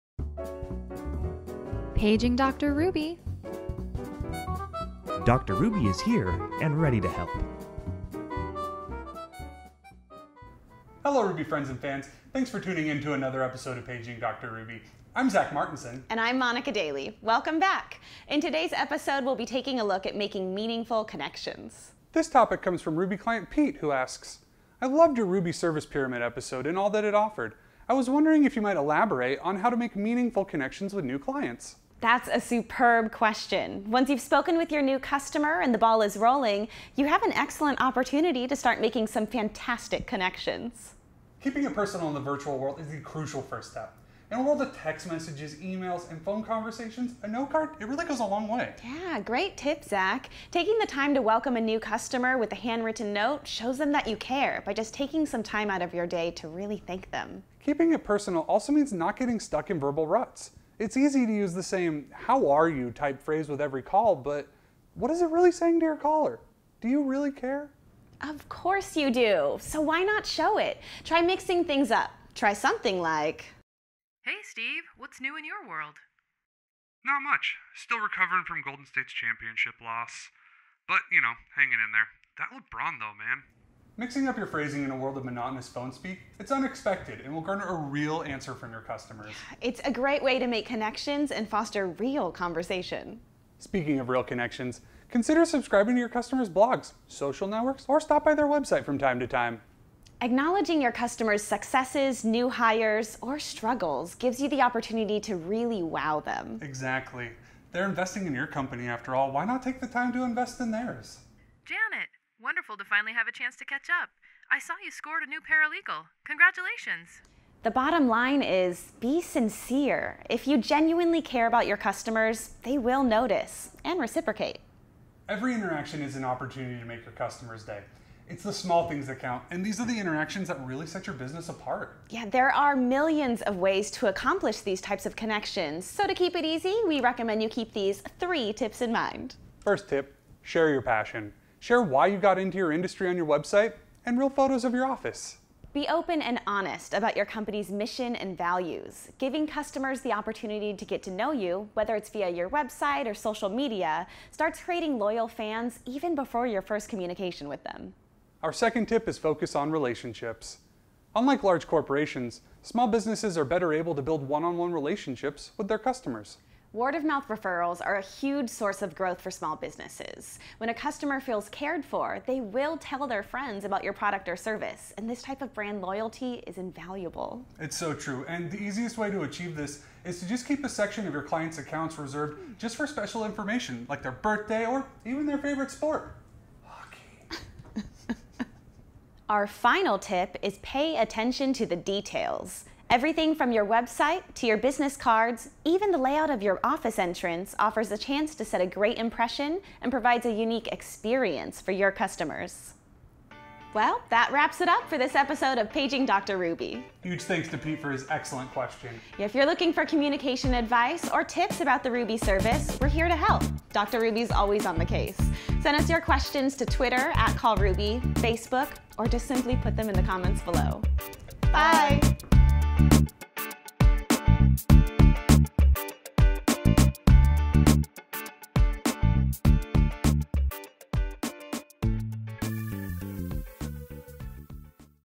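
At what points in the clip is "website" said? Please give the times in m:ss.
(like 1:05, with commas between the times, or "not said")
1:38, 2:23, 2:32, 3:13.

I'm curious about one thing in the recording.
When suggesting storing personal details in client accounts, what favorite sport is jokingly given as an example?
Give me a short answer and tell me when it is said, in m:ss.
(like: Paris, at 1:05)
Hockey, at 3:06.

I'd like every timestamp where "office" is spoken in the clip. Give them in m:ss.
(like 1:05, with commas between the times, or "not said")
2:24, 3:16.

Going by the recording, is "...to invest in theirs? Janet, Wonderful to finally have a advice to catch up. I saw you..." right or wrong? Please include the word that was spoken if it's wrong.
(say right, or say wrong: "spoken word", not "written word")
wrong: "chance", not "advice".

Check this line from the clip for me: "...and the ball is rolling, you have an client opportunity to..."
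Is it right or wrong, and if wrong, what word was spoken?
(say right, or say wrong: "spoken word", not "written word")
wrong: "excellent", not "client".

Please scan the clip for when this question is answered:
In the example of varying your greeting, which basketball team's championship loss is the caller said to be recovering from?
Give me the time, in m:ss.
1:18.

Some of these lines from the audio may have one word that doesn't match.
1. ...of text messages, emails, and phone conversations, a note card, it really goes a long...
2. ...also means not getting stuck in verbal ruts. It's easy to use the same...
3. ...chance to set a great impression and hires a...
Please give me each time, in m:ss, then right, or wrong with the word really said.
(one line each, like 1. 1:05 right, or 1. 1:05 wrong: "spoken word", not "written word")
1. 0:44 right
2. 0:58 right
3. 3:17 wrong: "provides", not "hires".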